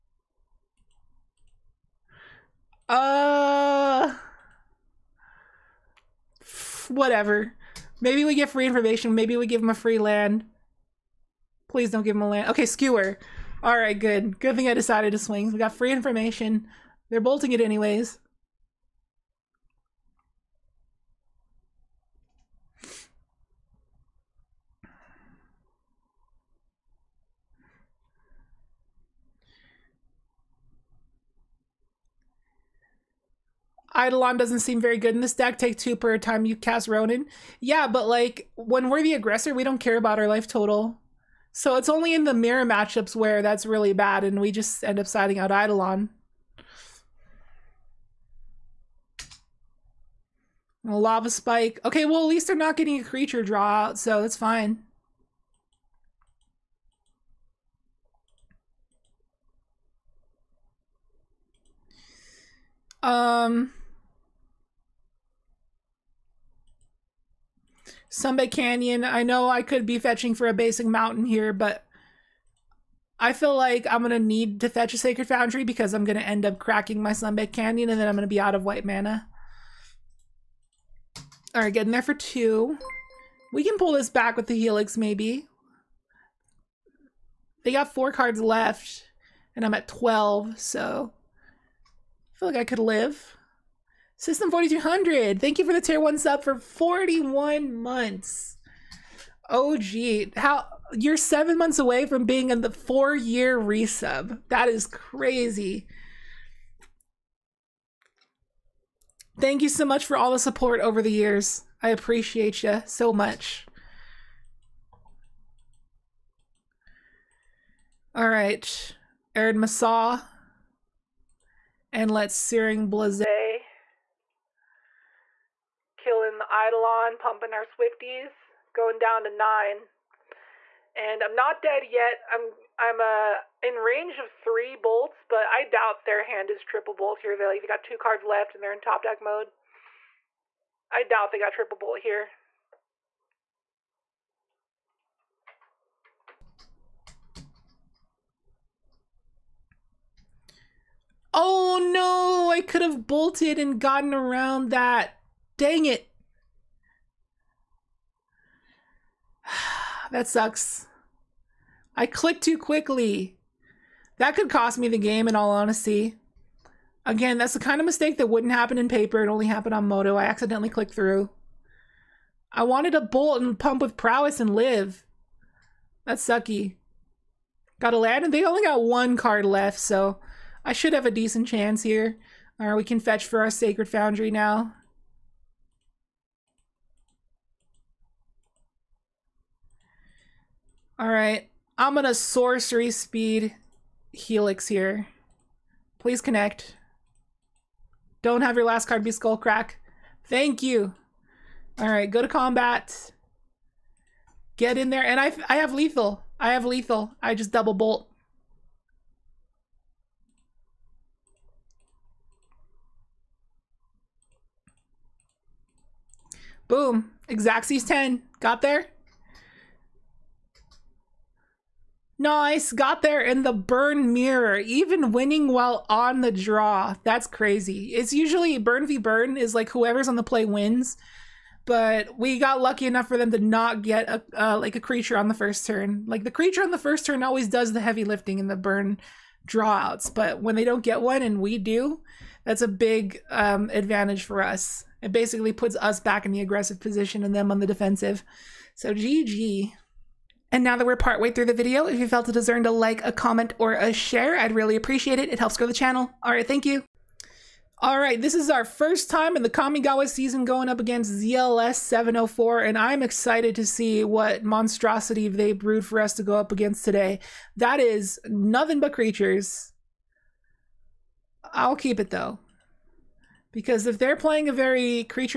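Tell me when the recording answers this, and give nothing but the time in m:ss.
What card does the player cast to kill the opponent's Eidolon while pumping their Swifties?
2:02.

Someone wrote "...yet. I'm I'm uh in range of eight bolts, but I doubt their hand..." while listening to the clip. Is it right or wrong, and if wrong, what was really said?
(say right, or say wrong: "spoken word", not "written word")
wrong: "three", not "eight".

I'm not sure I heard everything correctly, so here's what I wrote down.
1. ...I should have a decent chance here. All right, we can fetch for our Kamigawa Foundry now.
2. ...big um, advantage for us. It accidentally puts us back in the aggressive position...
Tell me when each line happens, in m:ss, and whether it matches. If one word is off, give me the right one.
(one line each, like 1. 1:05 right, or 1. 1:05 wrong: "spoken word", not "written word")
1. 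3:00 wrong: "Sacred", not "Kamigawa"
2. 4:02 wrong: "basically", not "accidentally".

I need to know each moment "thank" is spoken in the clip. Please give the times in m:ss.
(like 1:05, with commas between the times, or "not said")
1:35, 1:49, 3:20, 4:16.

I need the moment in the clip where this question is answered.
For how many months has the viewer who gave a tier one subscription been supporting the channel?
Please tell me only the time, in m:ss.
1:36.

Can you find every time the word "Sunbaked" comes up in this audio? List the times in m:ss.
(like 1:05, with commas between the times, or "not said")
1:08, 1:17.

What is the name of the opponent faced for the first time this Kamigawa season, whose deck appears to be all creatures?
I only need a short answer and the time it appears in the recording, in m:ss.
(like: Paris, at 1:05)
ZLS 704, at 4:21.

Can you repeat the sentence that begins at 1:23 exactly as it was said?
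We can pull this back with the Helix, maybe.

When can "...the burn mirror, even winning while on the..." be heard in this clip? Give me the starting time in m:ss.
3:43.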